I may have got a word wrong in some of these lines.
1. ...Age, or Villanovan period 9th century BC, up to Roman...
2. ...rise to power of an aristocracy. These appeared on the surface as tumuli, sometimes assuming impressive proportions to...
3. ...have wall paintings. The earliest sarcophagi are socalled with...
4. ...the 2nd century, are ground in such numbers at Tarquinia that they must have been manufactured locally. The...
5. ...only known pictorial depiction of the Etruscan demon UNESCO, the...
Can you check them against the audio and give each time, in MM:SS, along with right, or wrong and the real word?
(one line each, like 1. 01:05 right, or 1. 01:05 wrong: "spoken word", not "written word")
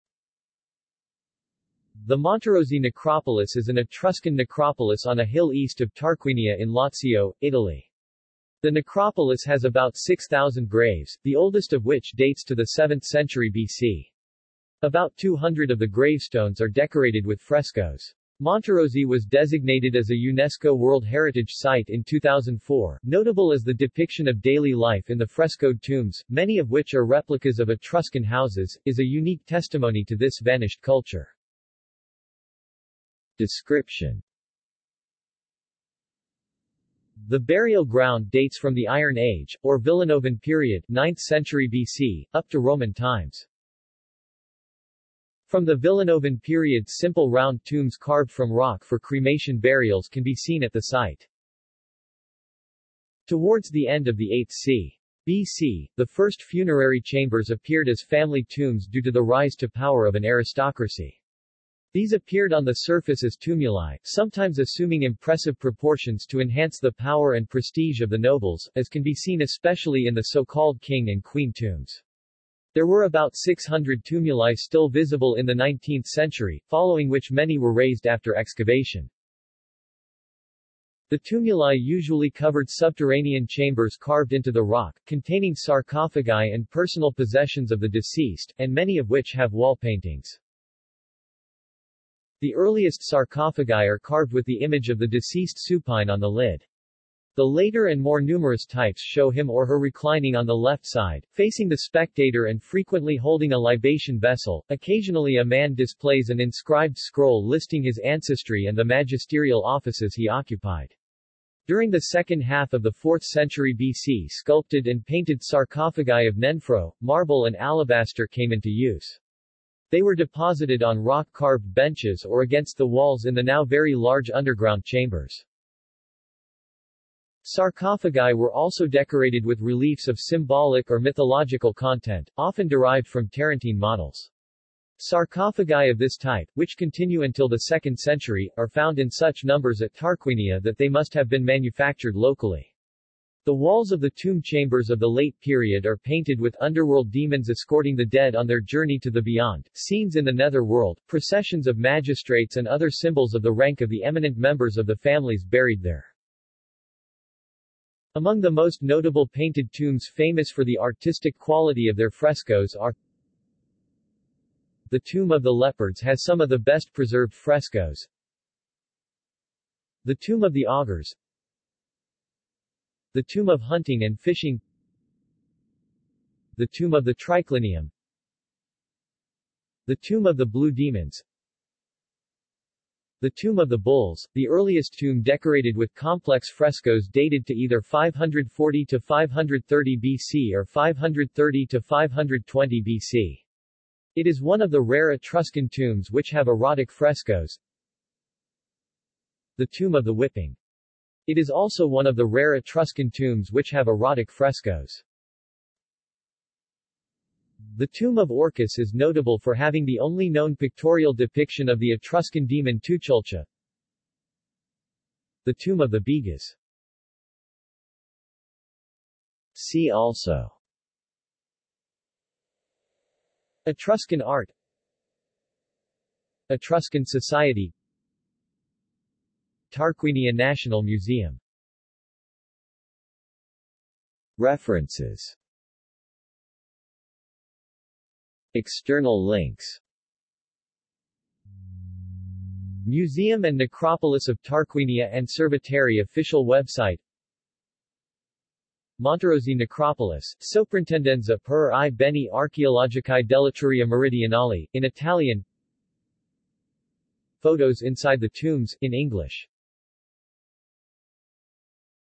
1. 00:39 right
2. 00:59 right
3. 01:29 wrong: "carved", not "socalled"
4. 02:17 wrong: "found", not "ground"
5. 03:29 wrong: "Tuchulcha", not "UNESCO".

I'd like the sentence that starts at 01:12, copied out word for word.
There were about 600 tumuli still visible in the 19th century, following which many were razed after excavation.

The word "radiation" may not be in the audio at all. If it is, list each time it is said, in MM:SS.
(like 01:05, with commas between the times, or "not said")
not said.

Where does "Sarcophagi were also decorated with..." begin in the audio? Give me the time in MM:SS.
02:07.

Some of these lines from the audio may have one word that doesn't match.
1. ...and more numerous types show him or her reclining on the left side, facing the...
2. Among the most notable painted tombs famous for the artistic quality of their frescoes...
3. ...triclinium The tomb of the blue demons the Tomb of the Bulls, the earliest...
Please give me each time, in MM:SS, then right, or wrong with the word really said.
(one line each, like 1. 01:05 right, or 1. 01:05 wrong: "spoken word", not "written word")
1. 01:37 right
2. 02:38 right
3. 02:57 right.